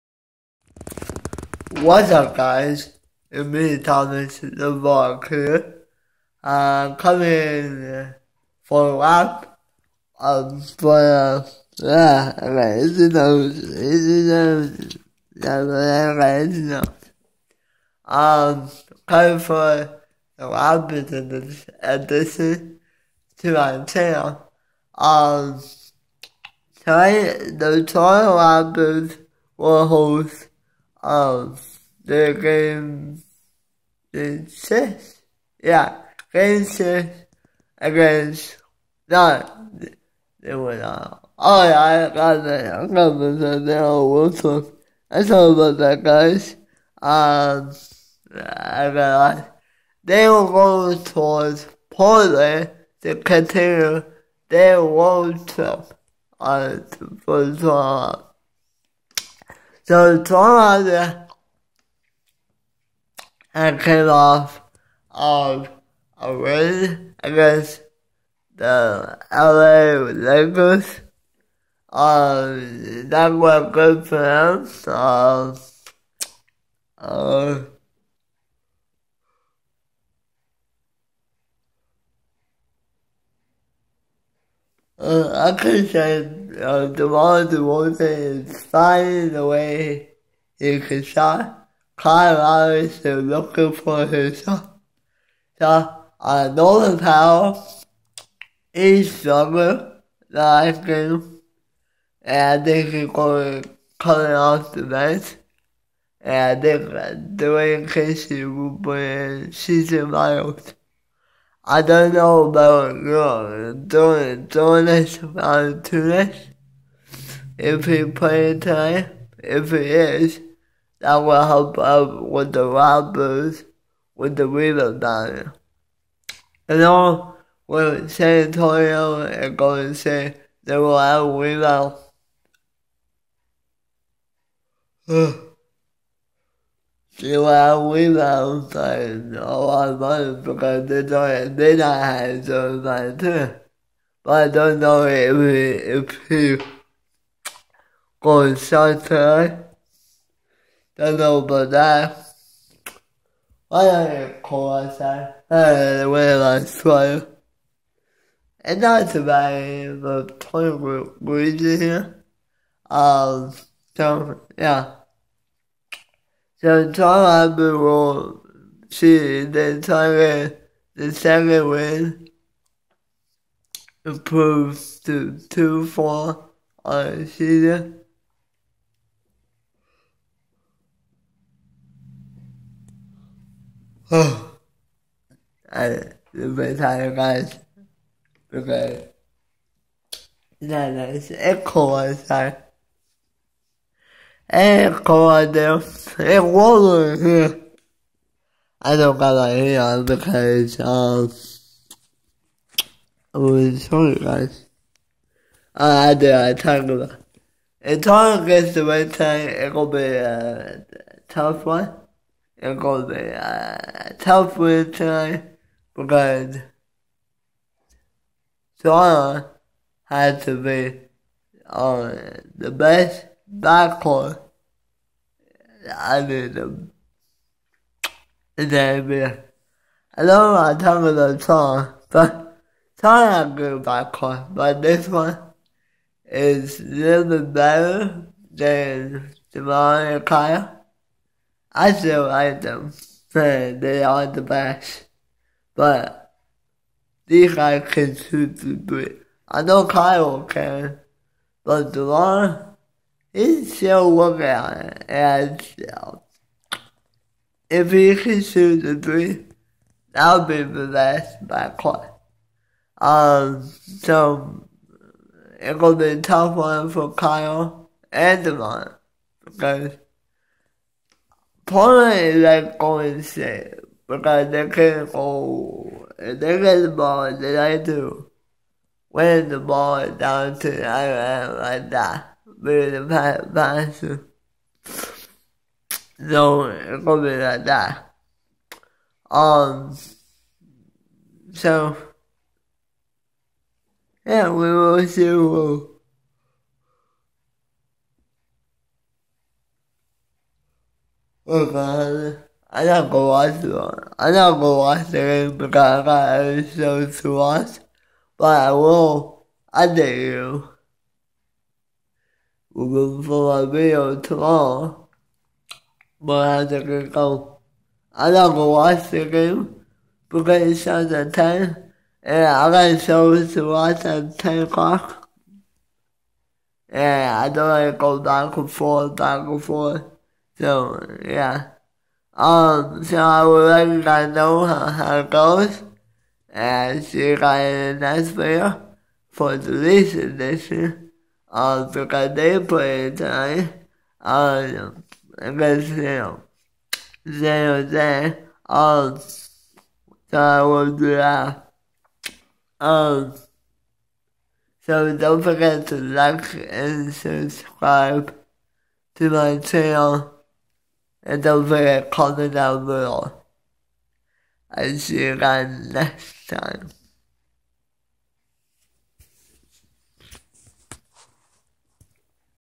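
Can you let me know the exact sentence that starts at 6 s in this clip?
I'm coming for a lap um for uh, yeah, okay, it's enough.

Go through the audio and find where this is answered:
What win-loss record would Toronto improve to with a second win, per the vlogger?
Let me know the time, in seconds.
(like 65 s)
175 s.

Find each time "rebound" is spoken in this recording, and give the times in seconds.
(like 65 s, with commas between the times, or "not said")
124 s, 131 s, 137 s.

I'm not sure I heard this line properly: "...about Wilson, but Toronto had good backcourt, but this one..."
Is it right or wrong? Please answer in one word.
wrong.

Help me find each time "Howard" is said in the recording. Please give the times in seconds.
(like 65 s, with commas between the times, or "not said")
not said.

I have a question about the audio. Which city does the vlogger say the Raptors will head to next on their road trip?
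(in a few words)
Portland.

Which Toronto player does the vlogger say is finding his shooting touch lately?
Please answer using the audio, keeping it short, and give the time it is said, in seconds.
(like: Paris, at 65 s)
DeMar DeRozan, at 86 s.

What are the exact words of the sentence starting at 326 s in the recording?
And I don't like to go back and forth, back and forth.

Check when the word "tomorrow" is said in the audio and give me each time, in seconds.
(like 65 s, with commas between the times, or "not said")
166 s, 314 s.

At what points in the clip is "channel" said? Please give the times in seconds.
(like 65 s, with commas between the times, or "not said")
23 s, 359 s.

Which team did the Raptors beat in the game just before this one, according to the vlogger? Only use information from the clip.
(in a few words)
LA Lakers.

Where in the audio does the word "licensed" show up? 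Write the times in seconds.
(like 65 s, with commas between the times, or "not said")
not said.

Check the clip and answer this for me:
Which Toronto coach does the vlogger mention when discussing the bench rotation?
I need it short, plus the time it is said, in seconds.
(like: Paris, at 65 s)
Dwane Casey, at 107 s.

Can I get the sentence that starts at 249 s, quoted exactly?
I know Kyle can, but Devon, he's still working on it.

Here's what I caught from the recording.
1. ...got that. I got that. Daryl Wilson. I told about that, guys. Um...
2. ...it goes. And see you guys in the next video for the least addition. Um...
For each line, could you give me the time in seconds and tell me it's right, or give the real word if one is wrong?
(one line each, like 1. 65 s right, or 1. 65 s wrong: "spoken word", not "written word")
1. 42 s right
2. 335 s wrong: "edition", not "addition".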